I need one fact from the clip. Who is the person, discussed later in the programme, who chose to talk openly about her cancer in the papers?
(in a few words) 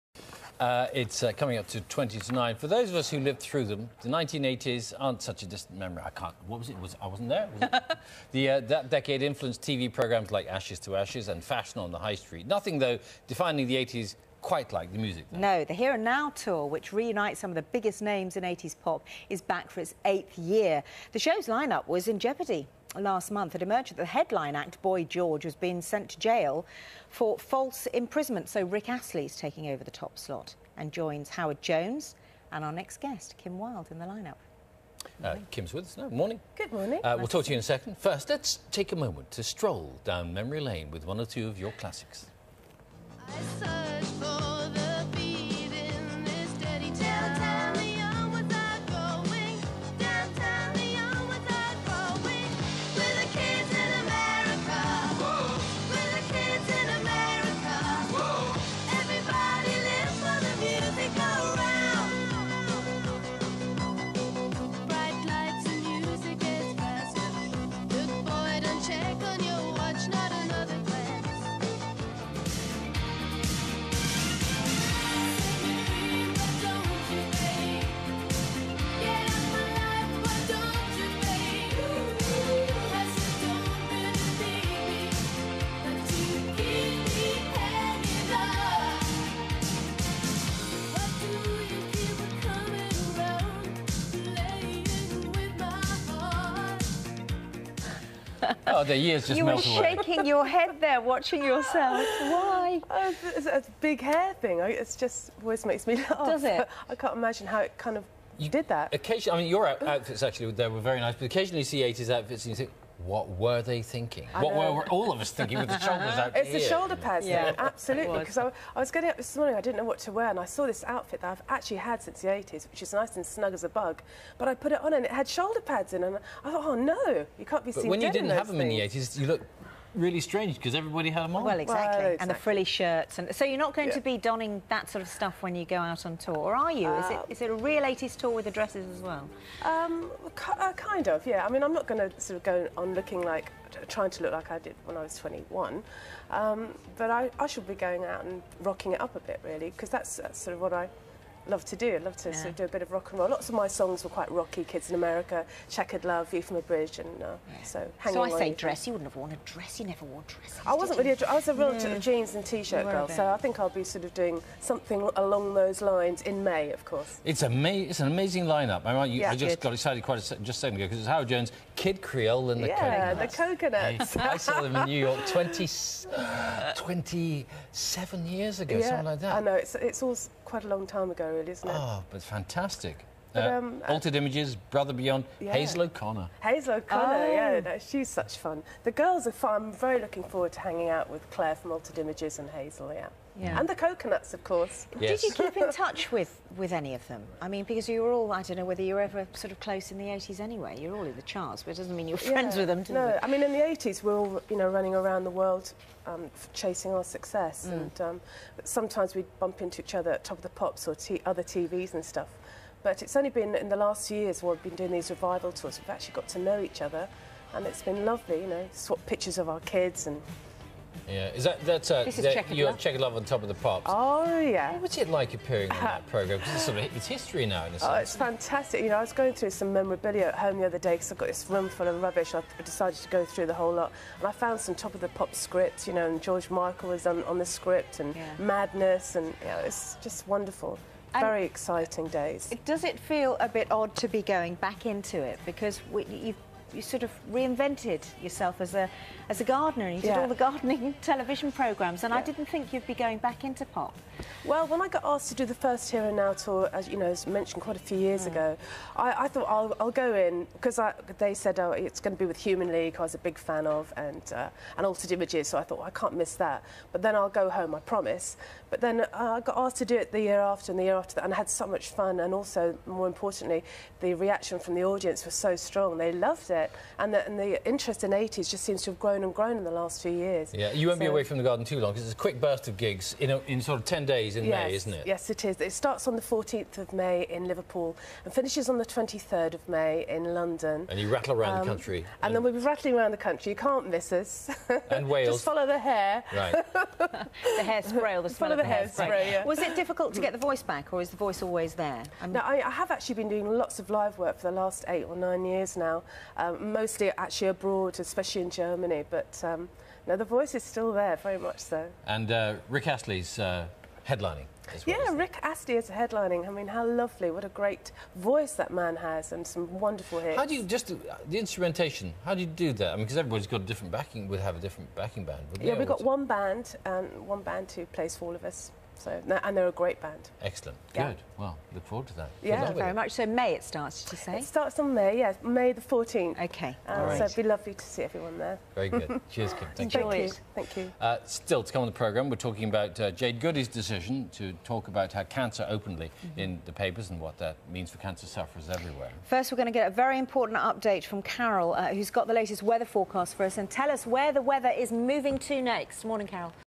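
Jade Goody.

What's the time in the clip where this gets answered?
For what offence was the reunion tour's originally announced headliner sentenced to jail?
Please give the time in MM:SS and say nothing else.
00:27.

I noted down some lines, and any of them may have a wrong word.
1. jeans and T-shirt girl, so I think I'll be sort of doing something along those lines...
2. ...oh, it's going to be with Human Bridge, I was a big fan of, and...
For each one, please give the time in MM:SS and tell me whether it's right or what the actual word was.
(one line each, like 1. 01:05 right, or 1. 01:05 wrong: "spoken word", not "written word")
1. 02:41 right
2. 04:21 wrong: "League", not "Bridge".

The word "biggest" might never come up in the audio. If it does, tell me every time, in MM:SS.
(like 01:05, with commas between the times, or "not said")
00:17.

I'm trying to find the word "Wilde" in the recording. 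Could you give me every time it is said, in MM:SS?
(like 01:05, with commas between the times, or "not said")
00:33.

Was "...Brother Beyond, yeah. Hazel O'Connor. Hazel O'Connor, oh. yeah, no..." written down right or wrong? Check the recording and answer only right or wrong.
right.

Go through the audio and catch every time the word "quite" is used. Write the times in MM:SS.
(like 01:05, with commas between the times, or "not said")
00:14, 02:34, 02:50, 03:00, 04:17.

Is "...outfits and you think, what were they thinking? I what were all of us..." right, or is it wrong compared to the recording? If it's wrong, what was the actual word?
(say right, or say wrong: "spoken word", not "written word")
right.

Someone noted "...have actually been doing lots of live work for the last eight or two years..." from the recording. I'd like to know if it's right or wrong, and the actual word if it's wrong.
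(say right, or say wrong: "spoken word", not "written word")
wrong: "nine", not "two".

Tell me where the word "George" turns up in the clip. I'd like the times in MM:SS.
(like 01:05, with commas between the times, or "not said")
00:25, 03:56.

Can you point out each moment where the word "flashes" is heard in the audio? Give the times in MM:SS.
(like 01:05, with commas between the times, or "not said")
not said.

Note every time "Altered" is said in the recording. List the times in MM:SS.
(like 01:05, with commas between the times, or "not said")
03:03, 03:11, 04:24.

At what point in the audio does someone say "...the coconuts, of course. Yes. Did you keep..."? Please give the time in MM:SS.
03:13.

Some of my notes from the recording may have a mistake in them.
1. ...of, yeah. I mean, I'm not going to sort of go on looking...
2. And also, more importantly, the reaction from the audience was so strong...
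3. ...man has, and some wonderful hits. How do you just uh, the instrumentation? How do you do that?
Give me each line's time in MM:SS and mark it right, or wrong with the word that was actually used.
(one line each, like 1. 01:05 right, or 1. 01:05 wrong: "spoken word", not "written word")
1. 02:21 right
2. 04:32 right
3. 05:18 right.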